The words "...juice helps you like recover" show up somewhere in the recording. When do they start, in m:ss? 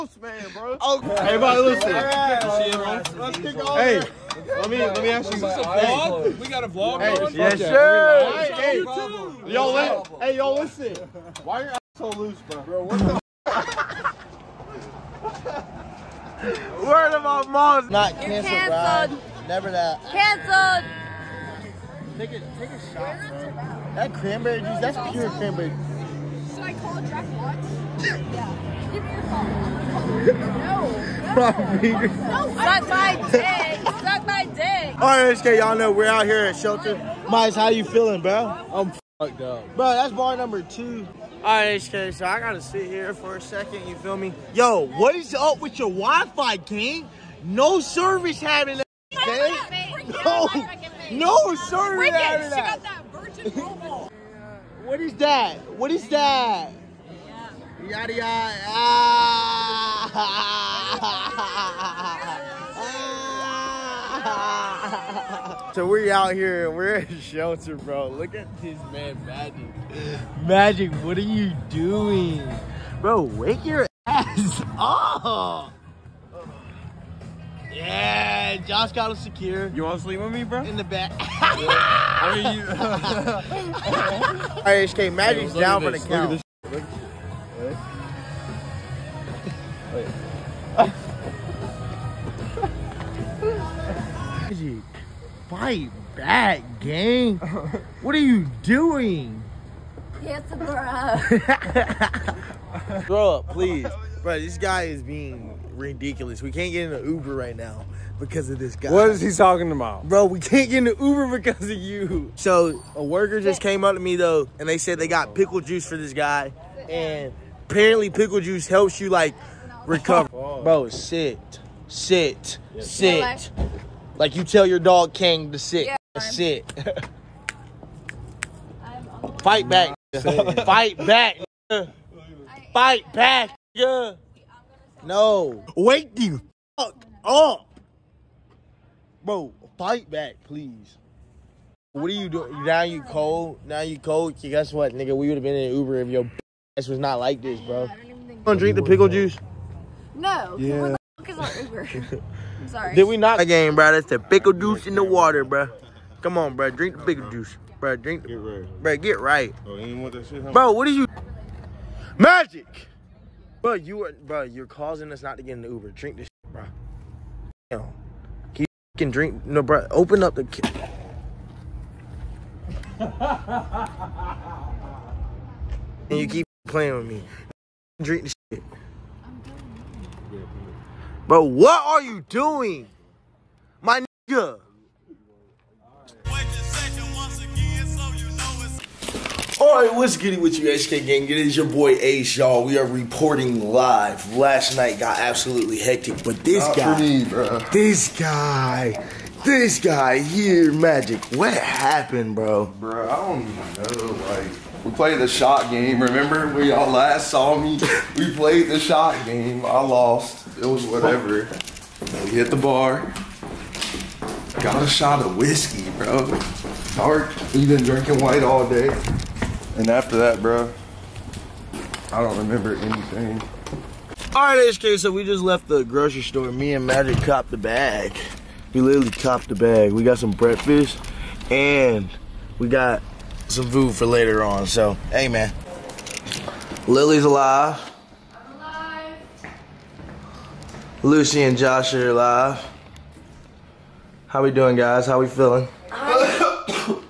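1:58.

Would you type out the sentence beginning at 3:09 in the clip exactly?
Alright, what's good with you, HK Gang?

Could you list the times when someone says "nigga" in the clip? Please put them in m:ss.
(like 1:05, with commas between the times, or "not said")
2:24, 3:04.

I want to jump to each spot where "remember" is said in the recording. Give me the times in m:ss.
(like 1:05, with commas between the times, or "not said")
3:26, 3:42.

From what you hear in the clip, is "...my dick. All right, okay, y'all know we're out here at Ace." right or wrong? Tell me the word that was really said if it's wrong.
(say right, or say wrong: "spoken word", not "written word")
wrong: "Shelter", not "Ace".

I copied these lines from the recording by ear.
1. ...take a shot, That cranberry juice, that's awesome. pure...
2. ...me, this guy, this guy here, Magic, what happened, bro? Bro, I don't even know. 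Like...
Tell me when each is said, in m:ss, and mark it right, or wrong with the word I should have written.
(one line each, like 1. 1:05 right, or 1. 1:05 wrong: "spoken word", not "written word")
1. 0:22 right
2. 3:16 right.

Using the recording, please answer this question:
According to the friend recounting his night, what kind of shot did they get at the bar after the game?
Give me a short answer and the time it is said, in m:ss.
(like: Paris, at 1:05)
Whiskey, at 3:35.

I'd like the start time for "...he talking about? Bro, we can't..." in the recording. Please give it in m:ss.
1:49.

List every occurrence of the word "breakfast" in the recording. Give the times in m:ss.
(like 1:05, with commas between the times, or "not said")
3:50.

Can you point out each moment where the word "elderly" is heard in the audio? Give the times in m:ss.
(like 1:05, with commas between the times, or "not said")
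not said.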